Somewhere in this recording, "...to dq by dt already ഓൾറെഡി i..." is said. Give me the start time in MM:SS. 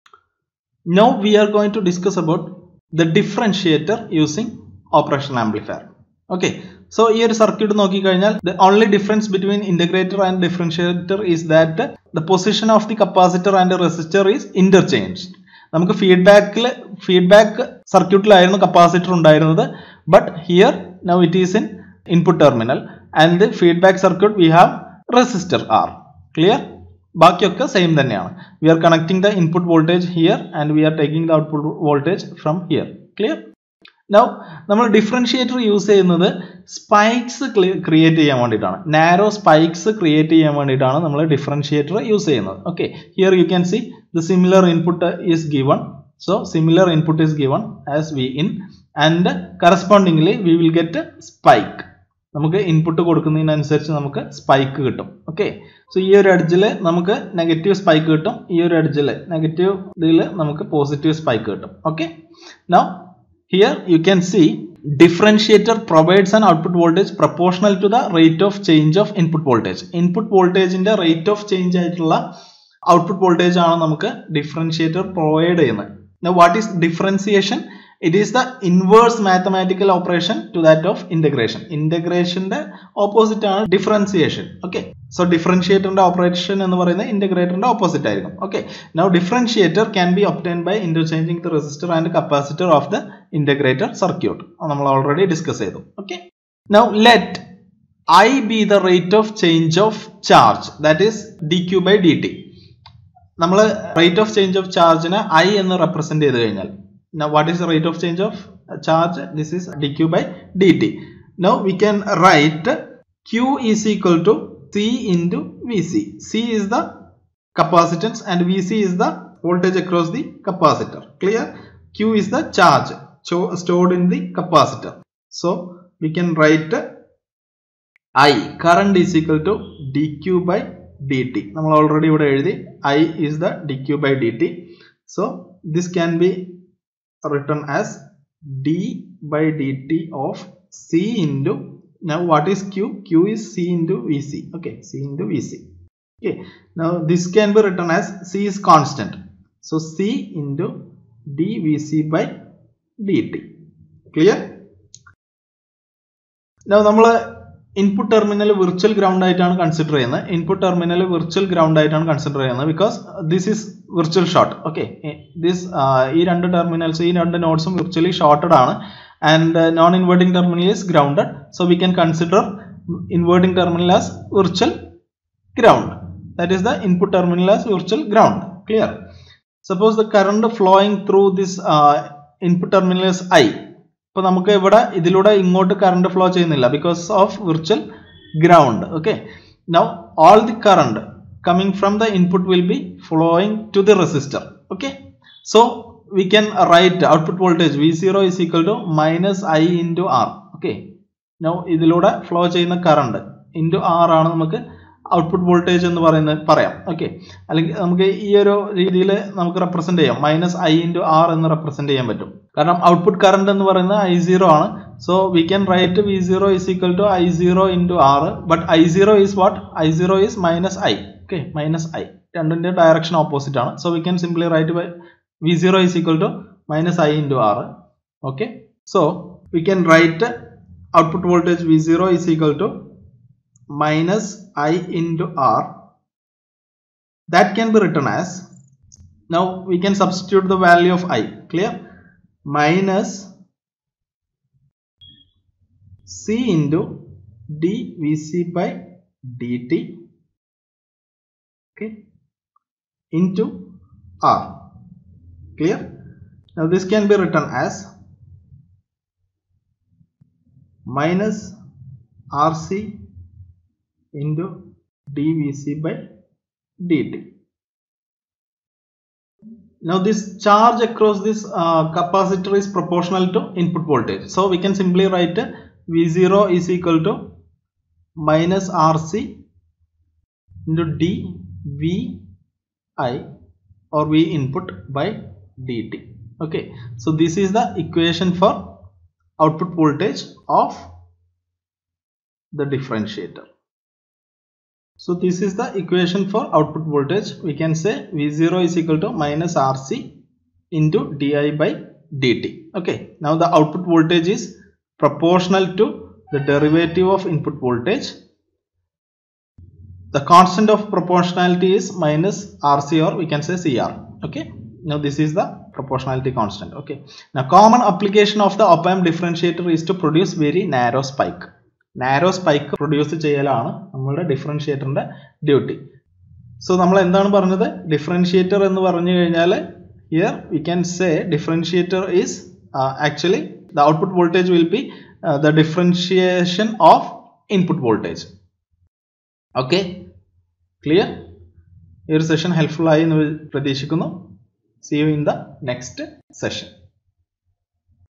02:09.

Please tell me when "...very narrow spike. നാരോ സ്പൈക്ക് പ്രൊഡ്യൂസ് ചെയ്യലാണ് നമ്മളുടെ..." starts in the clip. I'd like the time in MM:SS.
05:20.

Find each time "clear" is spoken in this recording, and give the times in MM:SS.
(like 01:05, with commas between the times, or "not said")
00:26, 02:01, 02:58, 04:01, 04:15.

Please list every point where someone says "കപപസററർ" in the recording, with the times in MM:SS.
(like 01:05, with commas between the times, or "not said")
00:18, 01:32.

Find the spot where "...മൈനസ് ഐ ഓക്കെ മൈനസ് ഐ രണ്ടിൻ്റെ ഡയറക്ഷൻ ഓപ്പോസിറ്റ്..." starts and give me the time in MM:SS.
03:40.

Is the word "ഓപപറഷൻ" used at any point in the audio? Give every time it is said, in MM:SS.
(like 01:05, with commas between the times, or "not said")
01:19, 01:26.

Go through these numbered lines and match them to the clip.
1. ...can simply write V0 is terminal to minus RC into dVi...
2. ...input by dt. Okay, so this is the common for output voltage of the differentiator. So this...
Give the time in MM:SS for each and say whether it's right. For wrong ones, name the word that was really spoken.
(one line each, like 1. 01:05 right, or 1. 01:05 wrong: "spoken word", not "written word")
1. 04:34 wrong: "equal", not "terminal"
2. 04:44 wrong: "equation", not "common".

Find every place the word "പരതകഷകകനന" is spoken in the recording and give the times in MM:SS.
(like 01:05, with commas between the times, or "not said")
05:43.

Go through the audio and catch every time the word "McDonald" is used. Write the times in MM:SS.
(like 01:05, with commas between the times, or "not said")
not said.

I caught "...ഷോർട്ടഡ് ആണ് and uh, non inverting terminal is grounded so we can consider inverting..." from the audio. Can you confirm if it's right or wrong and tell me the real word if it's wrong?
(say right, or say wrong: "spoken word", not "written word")
right.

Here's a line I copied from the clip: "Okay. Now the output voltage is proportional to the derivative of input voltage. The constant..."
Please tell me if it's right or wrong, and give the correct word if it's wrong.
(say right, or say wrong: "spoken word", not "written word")
right.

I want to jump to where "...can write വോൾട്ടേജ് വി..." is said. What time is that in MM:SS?
03:16.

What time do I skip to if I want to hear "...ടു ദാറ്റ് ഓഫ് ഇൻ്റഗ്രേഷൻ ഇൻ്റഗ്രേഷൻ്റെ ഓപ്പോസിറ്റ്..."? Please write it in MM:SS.
01:20.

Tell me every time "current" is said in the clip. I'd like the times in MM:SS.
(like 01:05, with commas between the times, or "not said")
02:08, 03:00.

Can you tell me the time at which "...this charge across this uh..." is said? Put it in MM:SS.
04:29.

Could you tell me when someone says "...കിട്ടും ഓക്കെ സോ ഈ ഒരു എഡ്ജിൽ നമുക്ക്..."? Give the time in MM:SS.
00:54.